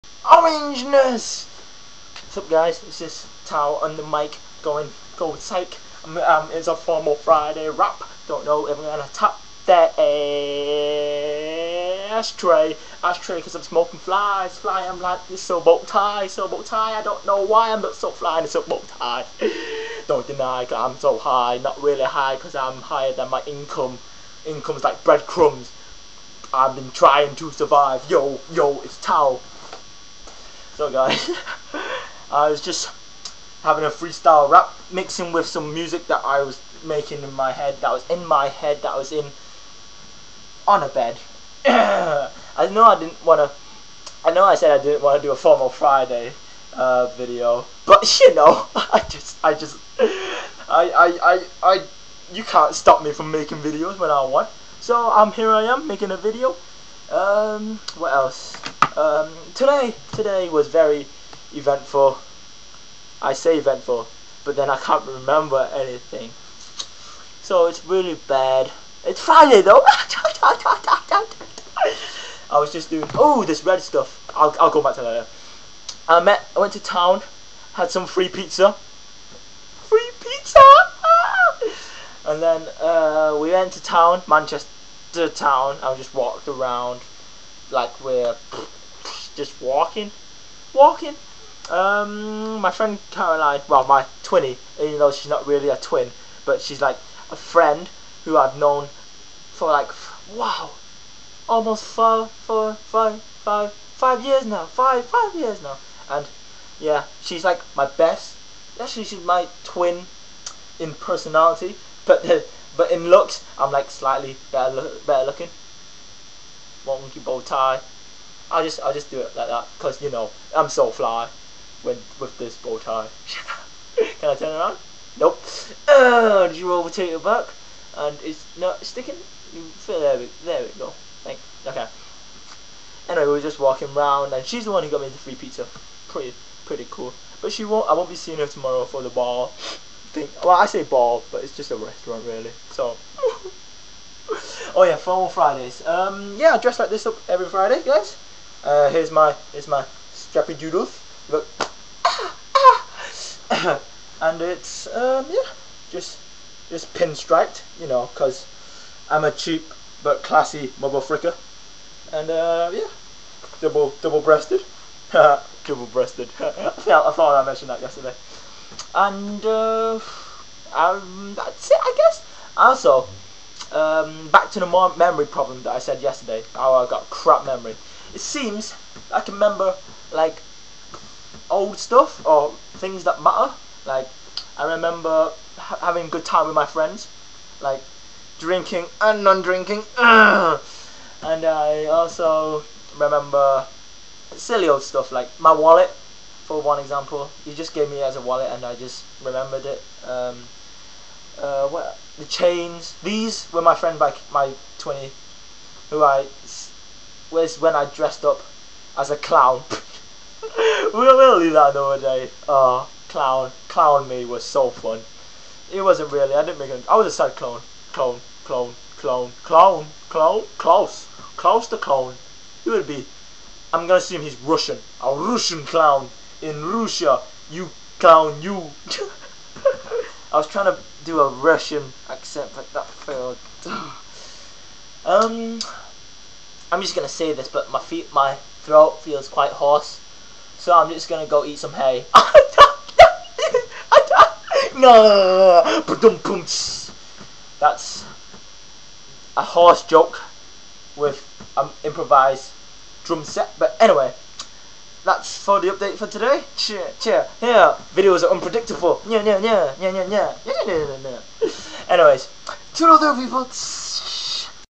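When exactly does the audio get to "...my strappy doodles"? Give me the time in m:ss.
2:29.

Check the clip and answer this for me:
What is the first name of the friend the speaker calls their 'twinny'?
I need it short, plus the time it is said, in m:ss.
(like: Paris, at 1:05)
Caroline, at 1:33.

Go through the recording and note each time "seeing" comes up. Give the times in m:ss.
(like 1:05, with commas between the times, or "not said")
2:18.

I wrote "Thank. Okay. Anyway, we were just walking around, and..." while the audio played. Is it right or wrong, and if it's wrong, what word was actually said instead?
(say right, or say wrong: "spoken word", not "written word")
right.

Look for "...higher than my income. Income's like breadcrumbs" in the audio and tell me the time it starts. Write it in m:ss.
0:22.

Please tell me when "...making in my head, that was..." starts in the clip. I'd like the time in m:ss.
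0:36.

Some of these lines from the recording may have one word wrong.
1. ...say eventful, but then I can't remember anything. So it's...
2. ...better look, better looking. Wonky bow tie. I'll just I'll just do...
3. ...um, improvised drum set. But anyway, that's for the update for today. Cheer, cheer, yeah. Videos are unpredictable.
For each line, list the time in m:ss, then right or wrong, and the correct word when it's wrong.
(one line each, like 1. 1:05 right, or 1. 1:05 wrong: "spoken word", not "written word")
1. 1:03 right
2. 1:54 right
3. 4:11 right.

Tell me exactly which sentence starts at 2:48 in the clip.
And uh, um, that's it, I guess.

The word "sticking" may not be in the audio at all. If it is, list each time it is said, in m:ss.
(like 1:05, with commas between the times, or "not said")
2:08.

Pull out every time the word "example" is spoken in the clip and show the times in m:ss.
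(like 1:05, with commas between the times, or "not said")
3:16.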